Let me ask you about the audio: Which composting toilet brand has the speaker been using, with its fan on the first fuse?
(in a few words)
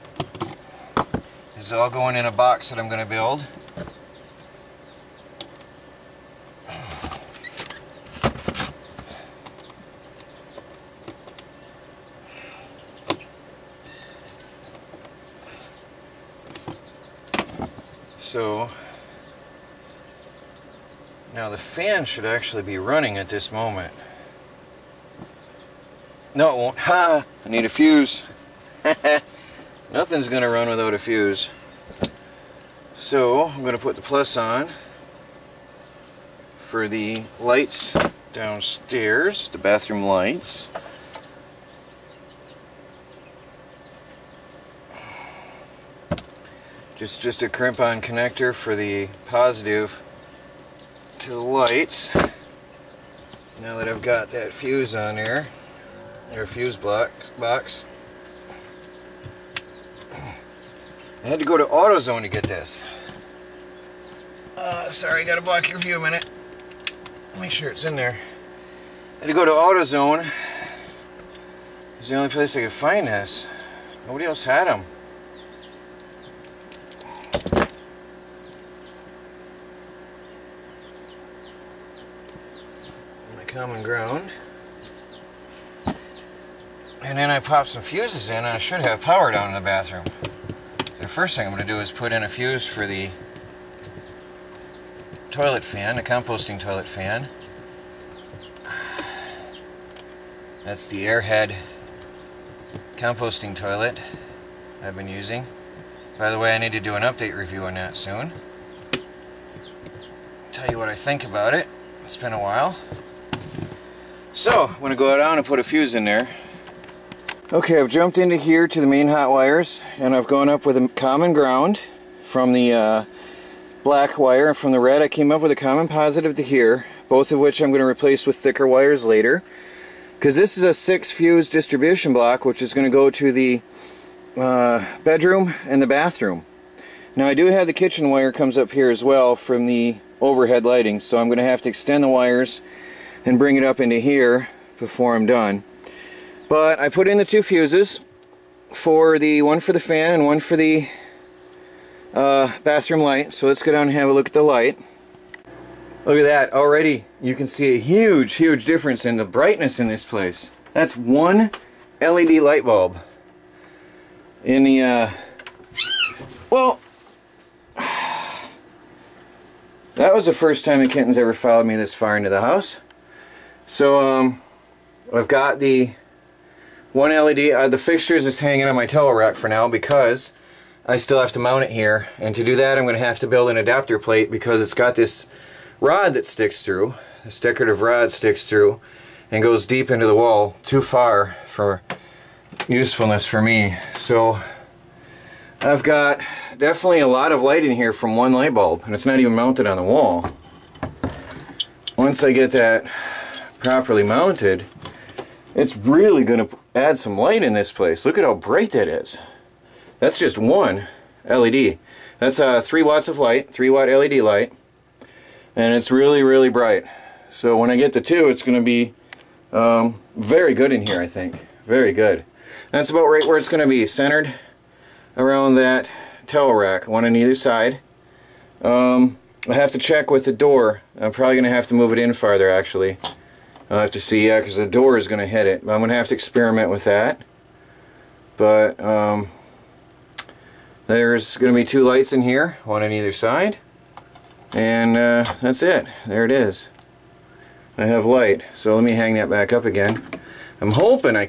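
Airhead.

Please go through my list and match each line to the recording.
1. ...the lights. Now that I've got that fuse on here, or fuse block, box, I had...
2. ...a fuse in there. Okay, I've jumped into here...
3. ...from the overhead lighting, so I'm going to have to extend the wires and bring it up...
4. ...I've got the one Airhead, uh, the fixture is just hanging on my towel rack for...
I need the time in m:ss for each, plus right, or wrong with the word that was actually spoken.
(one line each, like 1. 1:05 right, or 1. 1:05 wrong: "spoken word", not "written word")
1. 0:51 right
2. 1:55 right
3. 2:19 right
4. 2:55 wrong: "LED", not "Airhead".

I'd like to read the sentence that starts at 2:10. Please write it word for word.
Because this is a six fuse distribution block, which is going to go to the uh, bedroom and the bathroom.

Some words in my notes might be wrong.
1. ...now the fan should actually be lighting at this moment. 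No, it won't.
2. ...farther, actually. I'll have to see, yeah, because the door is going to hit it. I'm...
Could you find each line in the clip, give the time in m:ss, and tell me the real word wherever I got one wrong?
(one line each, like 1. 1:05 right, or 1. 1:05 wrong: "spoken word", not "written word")
1. 0:21 wrong: "running", not "lighting"
2. 3:52 right.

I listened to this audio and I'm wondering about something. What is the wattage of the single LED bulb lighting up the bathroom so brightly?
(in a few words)
3 watts.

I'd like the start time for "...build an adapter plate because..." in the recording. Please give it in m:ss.
3:03.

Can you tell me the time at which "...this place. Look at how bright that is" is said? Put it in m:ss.
3:27.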